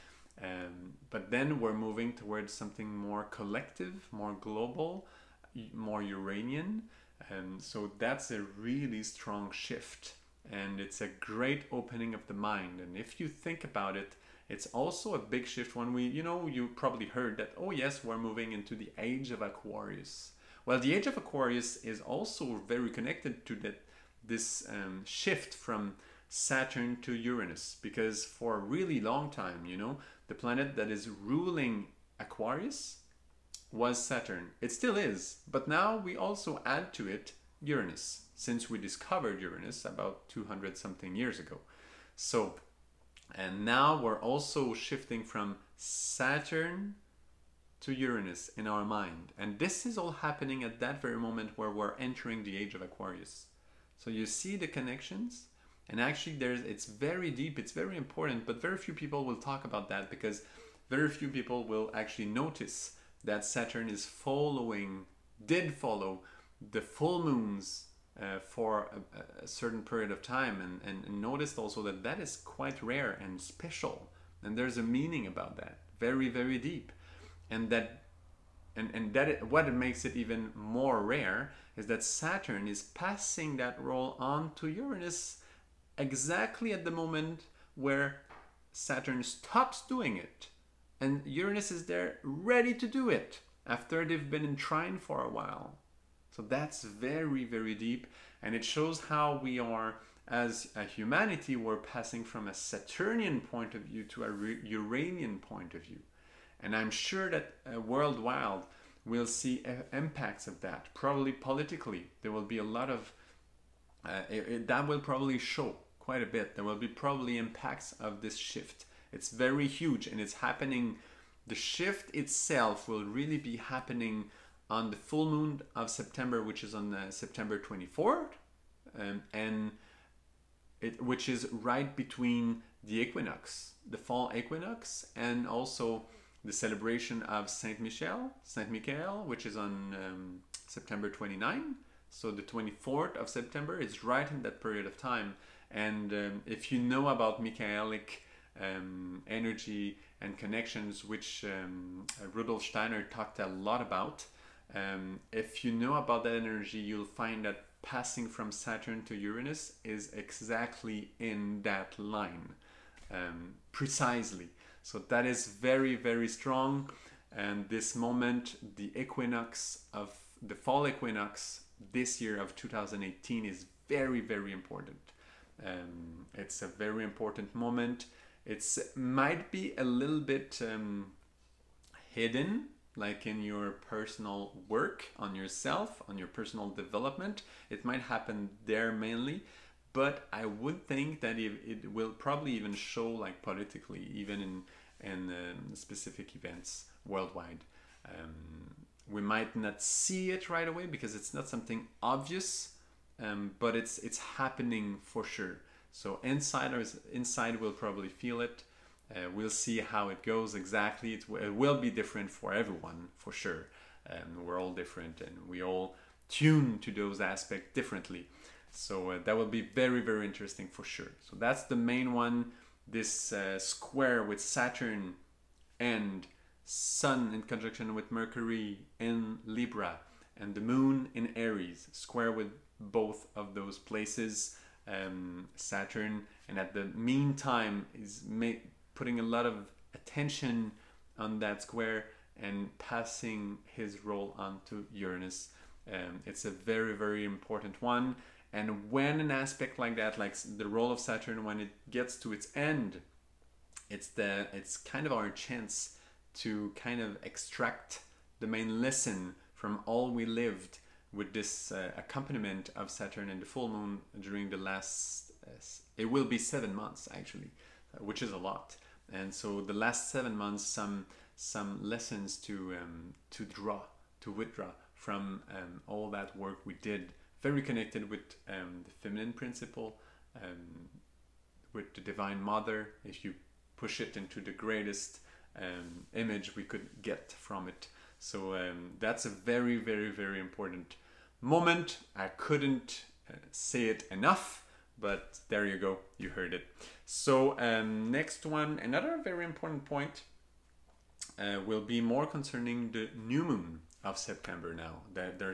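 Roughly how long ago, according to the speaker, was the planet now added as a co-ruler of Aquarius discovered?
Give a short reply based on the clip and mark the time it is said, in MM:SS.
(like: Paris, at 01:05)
200 something years ago, at 00:39.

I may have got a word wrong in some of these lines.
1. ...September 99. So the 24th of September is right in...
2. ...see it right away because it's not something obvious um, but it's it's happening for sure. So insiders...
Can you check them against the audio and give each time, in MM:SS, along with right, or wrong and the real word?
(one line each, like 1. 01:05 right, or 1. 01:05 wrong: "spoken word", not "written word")
1. 02:20 wrong: "29", not "99"
2. 03:19 right.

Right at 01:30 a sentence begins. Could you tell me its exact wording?
And Uranus is there ready to do it after they've been in trine for a while.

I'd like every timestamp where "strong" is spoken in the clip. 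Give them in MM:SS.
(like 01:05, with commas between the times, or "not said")
00:09, 02:46.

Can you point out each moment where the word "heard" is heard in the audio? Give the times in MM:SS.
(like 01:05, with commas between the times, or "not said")
00:17, 04:56.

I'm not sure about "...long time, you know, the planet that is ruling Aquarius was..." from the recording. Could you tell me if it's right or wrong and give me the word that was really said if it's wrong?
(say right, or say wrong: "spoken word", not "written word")
right.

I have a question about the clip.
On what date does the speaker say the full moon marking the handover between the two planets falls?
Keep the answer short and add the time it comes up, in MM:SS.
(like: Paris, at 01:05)
September 24th, at 02:07.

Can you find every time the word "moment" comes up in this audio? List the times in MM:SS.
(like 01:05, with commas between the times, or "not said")
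00:51, 01:26, 02:47, 02:57, 04:51.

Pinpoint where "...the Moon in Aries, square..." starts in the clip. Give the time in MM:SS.
03:50.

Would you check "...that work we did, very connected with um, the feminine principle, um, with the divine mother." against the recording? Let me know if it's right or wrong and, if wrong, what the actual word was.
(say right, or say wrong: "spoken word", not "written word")
right.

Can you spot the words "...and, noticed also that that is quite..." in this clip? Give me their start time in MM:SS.
01:11.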